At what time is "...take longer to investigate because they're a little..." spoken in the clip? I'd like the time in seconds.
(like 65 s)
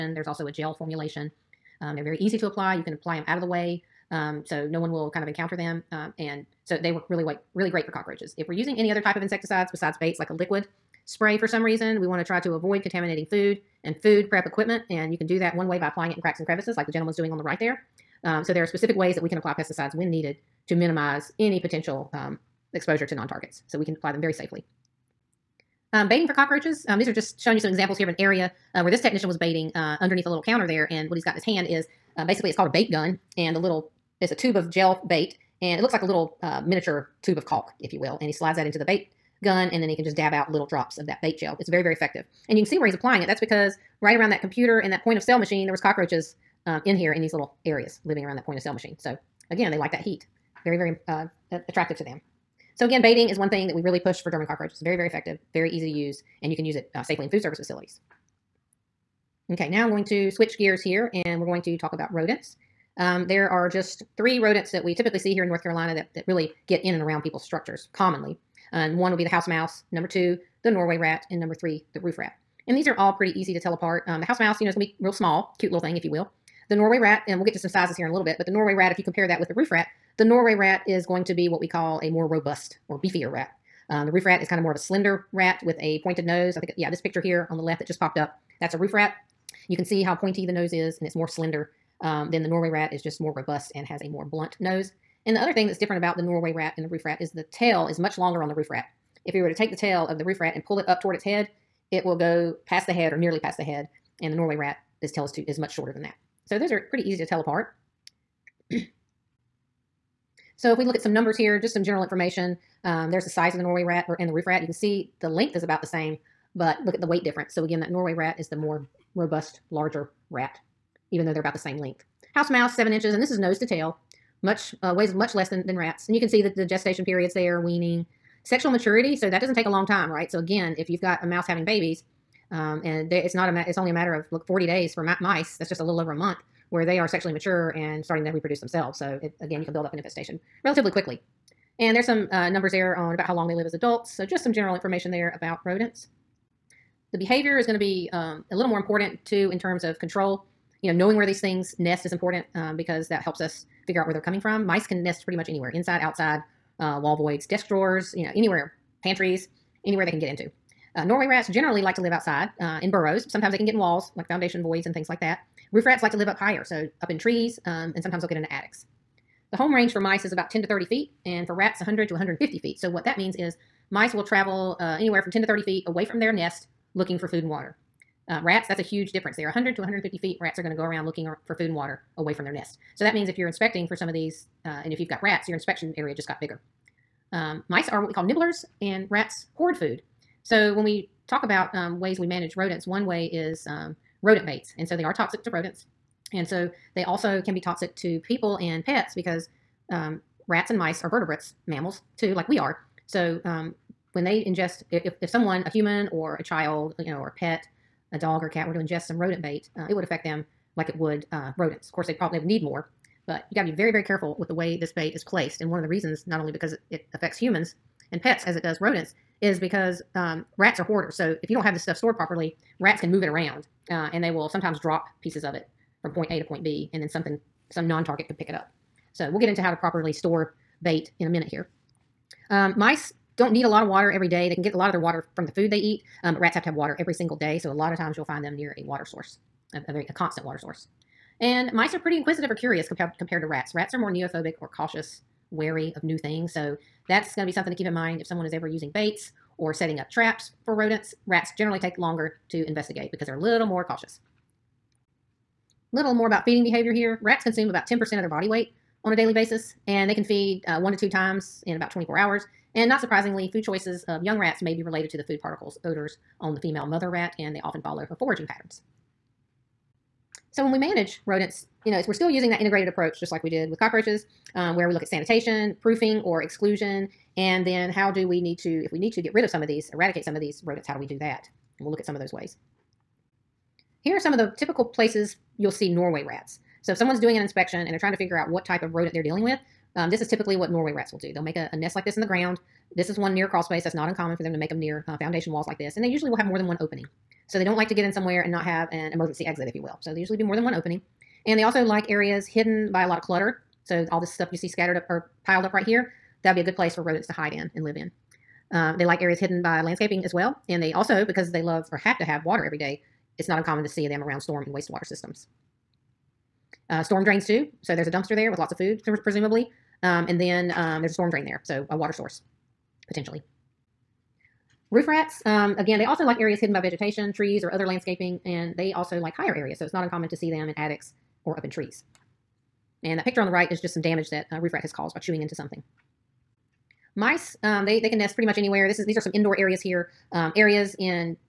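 251 s.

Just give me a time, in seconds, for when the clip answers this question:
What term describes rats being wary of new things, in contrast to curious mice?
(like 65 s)
244 s.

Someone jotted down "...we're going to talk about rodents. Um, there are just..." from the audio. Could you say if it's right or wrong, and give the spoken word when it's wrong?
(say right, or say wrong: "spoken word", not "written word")
right.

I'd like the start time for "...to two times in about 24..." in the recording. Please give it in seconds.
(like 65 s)
260 s.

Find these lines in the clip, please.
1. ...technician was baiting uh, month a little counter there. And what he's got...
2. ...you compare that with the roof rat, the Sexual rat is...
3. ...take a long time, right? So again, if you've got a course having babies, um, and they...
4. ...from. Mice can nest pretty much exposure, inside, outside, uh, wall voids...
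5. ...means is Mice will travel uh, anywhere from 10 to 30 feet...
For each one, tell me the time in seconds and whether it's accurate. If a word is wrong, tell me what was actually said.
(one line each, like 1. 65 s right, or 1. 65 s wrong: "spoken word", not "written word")
1. 29 s wrong: "underneath", not "month"
2. 78 s wrong: "Norway", not "Sexual"
3. 129 s wrong: "mouse", not "course"
4. 154 s wrong: "anywhere", not "exposure"
5. 173 s right.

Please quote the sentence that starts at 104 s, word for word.
And the Norway rat, this tail is, too, is much shorter than that.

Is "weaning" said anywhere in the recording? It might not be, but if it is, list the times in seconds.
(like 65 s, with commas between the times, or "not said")
127 s.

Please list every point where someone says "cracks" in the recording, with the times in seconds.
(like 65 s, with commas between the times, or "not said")
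16 s.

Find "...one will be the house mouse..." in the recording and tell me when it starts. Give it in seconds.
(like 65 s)
68 s.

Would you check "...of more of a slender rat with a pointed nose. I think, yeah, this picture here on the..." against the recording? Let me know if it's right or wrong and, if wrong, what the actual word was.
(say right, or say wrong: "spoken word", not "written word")
right.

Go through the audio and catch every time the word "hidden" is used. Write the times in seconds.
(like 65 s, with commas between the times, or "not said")
302 s, 309 s, 326 s.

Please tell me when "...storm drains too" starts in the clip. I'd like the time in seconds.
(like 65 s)
317 s.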